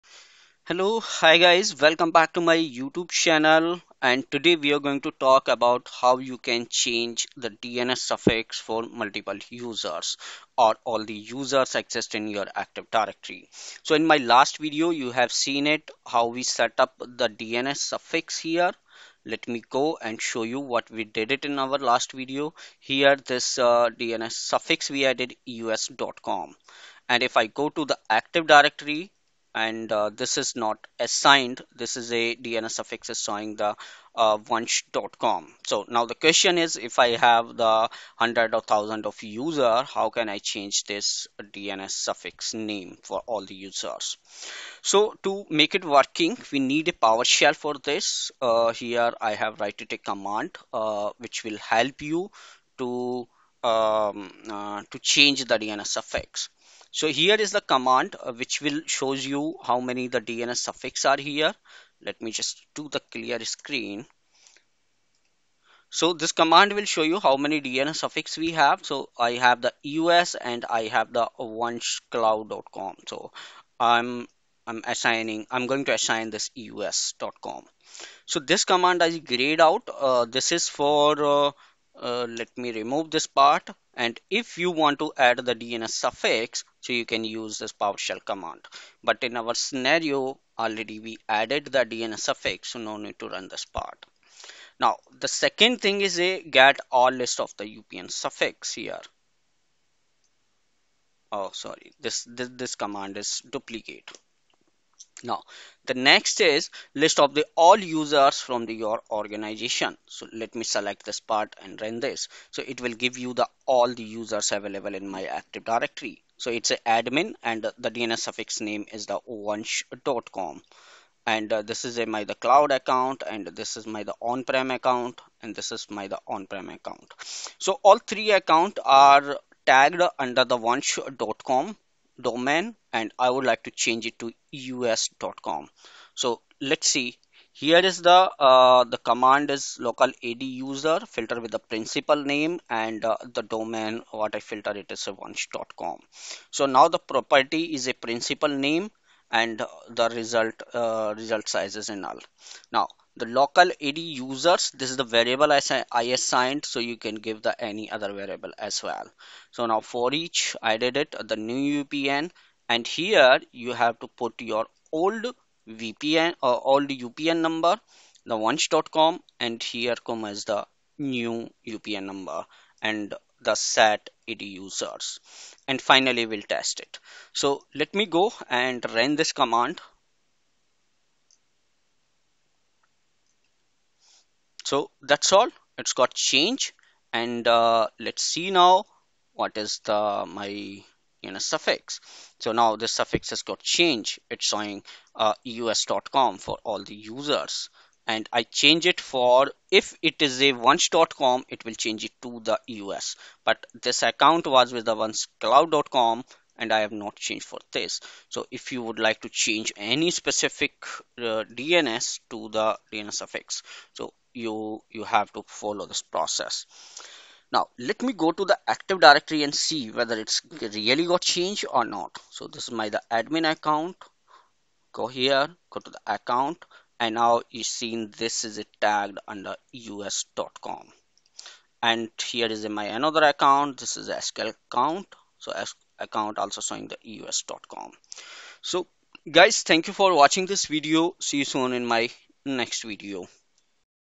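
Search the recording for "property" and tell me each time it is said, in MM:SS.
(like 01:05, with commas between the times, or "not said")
02:27.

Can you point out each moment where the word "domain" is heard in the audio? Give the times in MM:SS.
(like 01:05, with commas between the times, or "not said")
02:12, 02:23.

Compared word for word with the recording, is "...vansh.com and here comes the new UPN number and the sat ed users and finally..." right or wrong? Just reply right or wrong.
right.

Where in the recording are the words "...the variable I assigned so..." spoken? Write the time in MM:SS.
02:35.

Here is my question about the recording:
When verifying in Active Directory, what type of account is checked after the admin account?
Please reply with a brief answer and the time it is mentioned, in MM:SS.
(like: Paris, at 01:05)
SQL account, at 03:53.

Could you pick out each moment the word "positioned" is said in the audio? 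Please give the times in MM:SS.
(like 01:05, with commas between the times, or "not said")
not said.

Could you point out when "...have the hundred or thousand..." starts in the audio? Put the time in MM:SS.
00:37.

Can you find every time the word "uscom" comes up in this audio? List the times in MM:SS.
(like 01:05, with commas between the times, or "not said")
00:25, 01:16, 02:14, 03:15, 03:49, 03:57.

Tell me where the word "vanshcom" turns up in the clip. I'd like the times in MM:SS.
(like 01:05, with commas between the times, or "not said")
01:59, 02:10, 02:25, 02:48, 03:20.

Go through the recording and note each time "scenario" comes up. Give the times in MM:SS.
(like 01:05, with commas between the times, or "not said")
01:29.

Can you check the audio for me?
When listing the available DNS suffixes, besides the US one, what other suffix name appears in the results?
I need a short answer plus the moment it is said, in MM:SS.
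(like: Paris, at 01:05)
onecloud.com, at 01:11.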